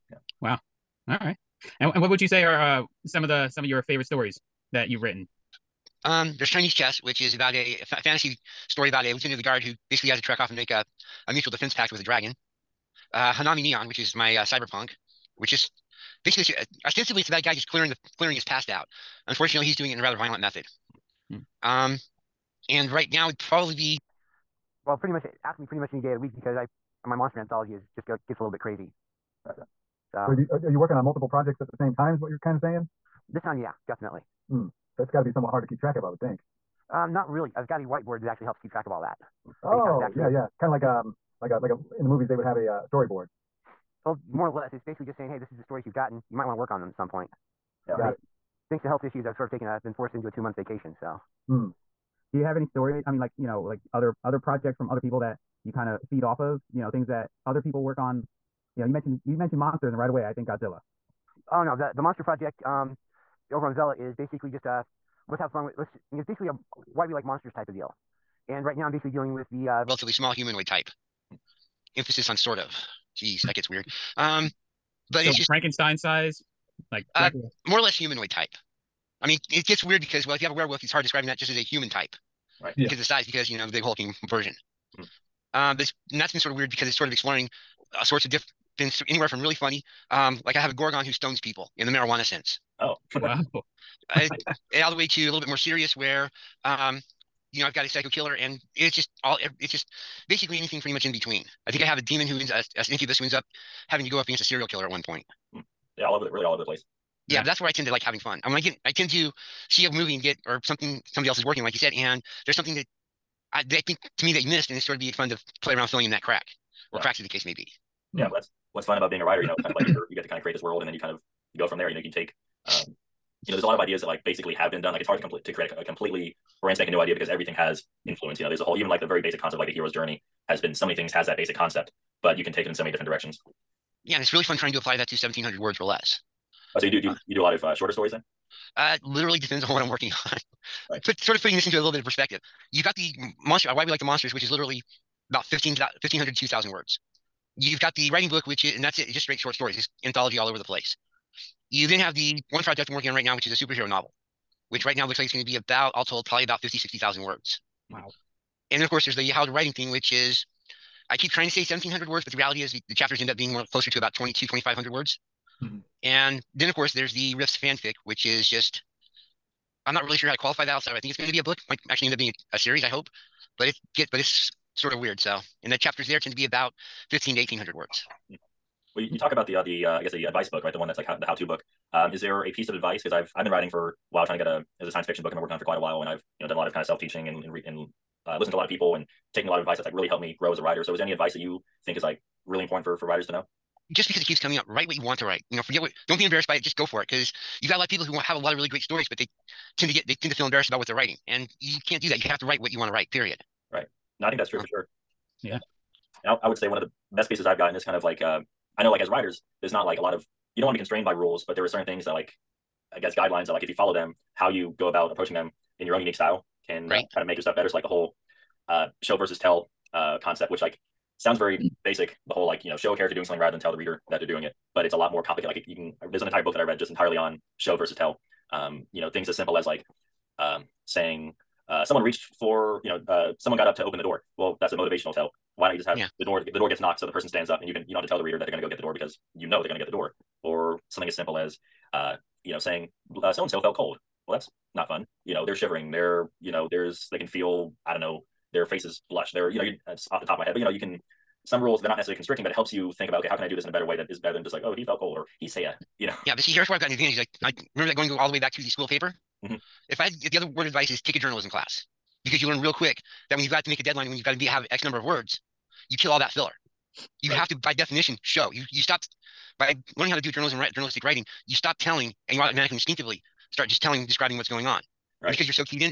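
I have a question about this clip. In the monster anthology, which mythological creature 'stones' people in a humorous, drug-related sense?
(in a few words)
Gorgon.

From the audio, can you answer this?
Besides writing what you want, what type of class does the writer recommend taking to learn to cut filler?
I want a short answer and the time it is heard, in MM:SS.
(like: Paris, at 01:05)
Journalism class, at 04:21.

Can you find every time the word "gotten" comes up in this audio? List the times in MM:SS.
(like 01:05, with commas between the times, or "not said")
00:45, 03:27.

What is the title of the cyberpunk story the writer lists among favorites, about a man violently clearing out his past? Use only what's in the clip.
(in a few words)
Hanami Neon.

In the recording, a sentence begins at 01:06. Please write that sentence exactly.
It's basically a why we like monsters type of deal.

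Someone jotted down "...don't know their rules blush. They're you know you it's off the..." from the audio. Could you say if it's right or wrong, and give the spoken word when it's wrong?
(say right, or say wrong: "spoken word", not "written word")
wrong: "faces", not "rules".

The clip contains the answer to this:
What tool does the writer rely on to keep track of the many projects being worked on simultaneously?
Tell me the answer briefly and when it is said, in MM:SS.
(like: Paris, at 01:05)
Whiteboard, at 00:37.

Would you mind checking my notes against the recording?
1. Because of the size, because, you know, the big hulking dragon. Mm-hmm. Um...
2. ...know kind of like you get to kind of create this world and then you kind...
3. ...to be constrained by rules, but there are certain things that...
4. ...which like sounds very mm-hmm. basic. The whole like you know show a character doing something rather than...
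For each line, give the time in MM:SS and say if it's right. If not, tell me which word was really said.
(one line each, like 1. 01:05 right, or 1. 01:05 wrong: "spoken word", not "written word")
1. 01:22 wrong: "version", not "dragon"
2. 01:59 right
3. 03:30 right
4. 03:40 right.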